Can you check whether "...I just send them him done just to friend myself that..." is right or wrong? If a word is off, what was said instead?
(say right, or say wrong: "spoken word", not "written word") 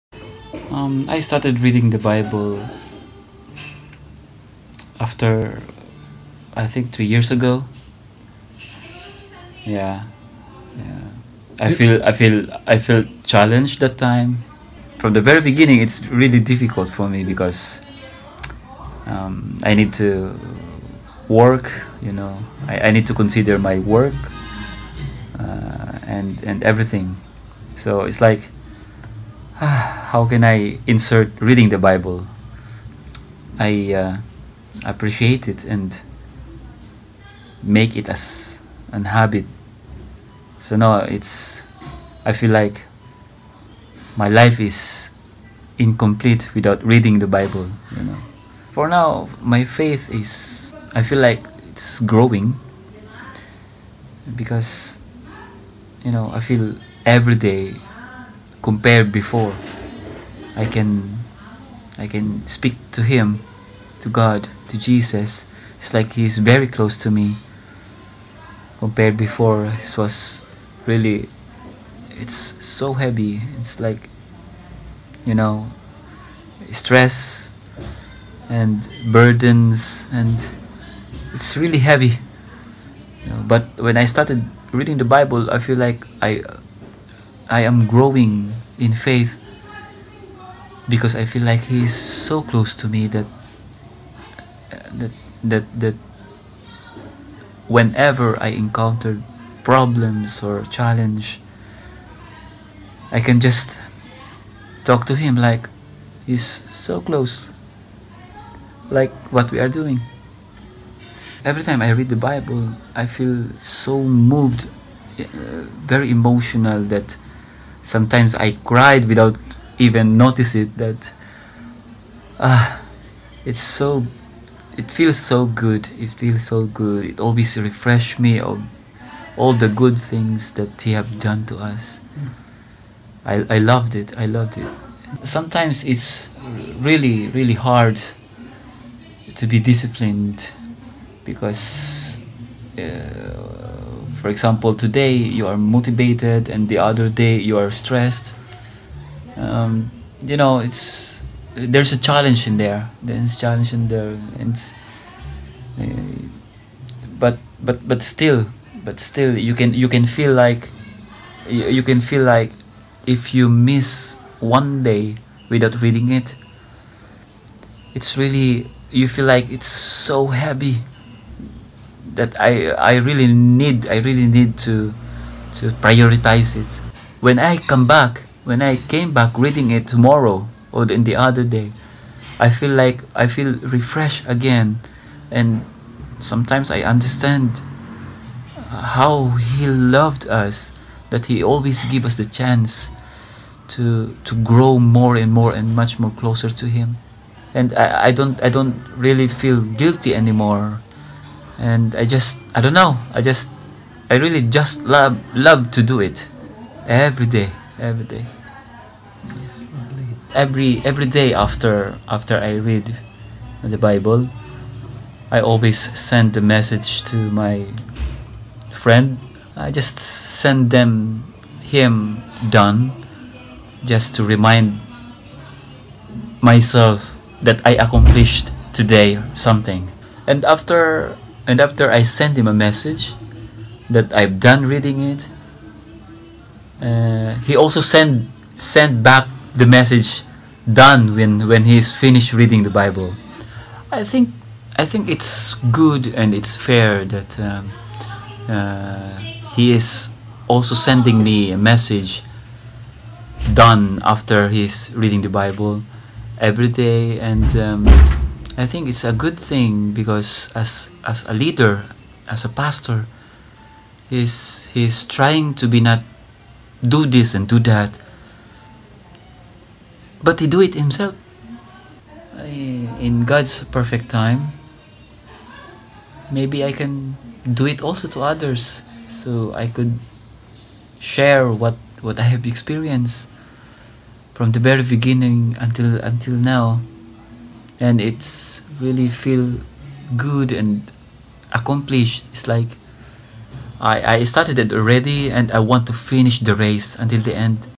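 wrong: "remind", not "friend".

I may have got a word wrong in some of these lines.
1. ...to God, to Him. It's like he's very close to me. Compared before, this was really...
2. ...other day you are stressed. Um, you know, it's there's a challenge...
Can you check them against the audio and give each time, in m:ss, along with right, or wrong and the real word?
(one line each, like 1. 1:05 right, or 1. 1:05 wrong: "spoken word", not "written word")
1. 1:04 wrong: "Jesus", not "Him"
2. 2:26 right.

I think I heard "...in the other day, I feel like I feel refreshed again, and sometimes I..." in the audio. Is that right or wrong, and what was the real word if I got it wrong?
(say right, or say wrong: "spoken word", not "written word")
right.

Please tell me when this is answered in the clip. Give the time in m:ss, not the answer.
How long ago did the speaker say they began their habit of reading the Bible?
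0:06.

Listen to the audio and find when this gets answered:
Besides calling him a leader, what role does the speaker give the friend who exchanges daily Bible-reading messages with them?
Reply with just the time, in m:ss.
4:22.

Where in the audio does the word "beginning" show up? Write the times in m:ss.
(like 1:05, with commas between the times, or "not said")
0:15, 4:44.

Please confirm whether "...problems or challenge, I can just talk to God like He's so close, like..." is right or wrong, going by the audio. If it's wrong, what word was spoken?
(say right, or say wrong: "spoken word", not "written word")
wrong: "Him", not "God".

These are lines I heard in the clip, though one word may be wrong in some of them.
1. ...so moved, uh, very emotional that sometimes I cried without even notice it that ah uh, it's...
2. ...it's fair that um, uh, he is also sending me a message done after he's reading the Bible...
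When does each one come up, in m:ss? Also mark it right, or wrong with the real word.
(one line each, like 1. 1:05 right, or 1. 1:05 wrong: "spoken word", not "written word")
1. 1:53 right
2. 4:06 right.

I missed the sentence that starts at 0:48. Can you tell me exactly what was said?
For now, my faith is, I feel like it's growing because, you know, I feel every day compared before.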